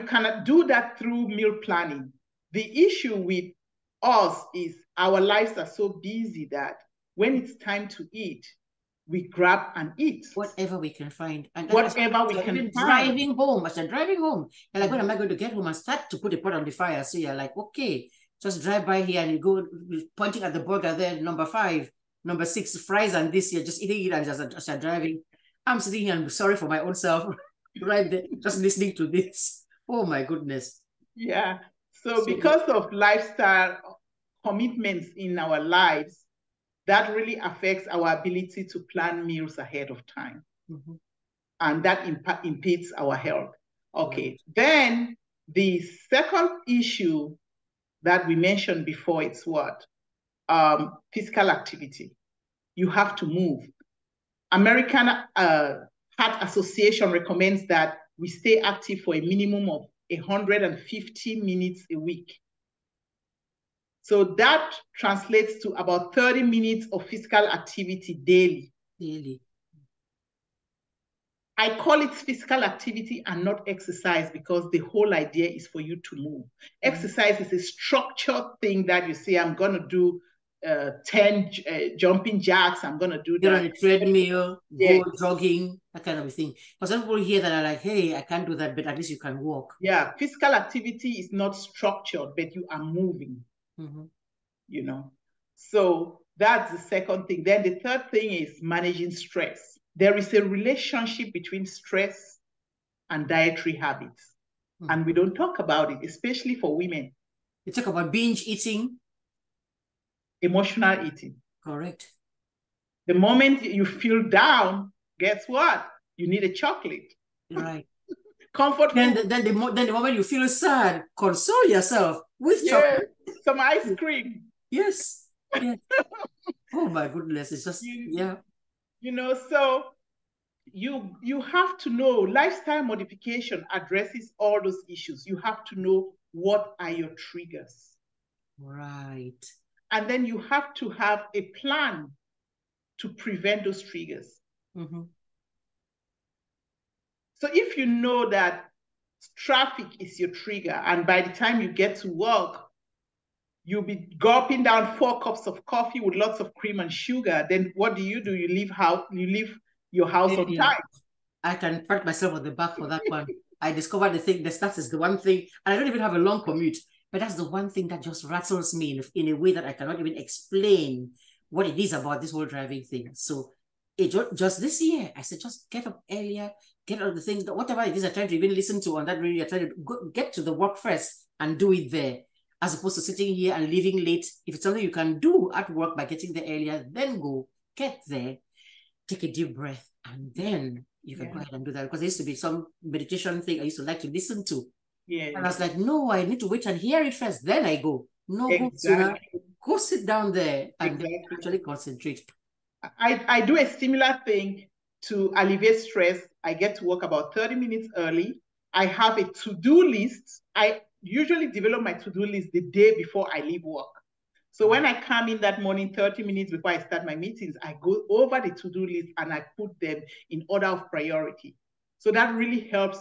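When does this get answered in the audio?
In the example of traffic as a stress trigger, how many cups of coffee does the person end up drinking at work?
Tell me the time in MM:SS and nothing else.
02:34.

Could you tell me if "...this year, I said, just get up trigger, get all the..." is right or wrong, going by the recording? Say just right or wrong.
wrong.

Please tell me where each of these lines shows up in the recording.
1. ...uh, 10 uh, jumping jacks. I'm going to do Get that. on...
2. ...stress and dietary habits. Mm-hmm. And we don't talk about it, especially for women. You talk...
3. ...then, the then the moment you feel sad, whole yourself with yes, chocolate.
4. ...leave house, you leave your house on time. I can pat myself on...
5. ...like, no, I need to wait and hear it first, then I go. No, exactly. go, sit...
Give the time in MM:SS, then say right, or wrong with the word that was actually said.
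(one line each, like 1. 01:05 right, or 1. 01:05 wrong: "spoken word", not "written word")
1. 01:20 right
2. 01:41 right
3. 01:59 wrong: "console", not "whole"
4. 02:38 right
5. 03:15 right.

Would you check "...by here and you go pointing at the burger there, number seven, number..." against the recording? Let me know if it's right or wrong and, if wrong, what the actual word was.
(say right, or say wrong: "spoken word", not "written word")
wrong: "five", not "seven".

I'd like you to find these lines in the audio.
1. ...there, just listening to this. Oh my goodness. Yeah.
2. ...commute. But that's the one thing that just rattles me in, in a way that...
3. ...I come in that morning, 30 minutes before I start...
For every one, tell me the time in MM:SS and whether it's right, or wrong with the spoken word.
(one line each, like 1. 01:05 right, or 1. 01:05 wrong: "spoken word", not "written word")
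1. 00:28 right
2. 02:46 right
3. 03:34 right.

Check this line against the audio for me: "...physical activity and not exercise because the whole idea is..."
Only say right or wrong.
right.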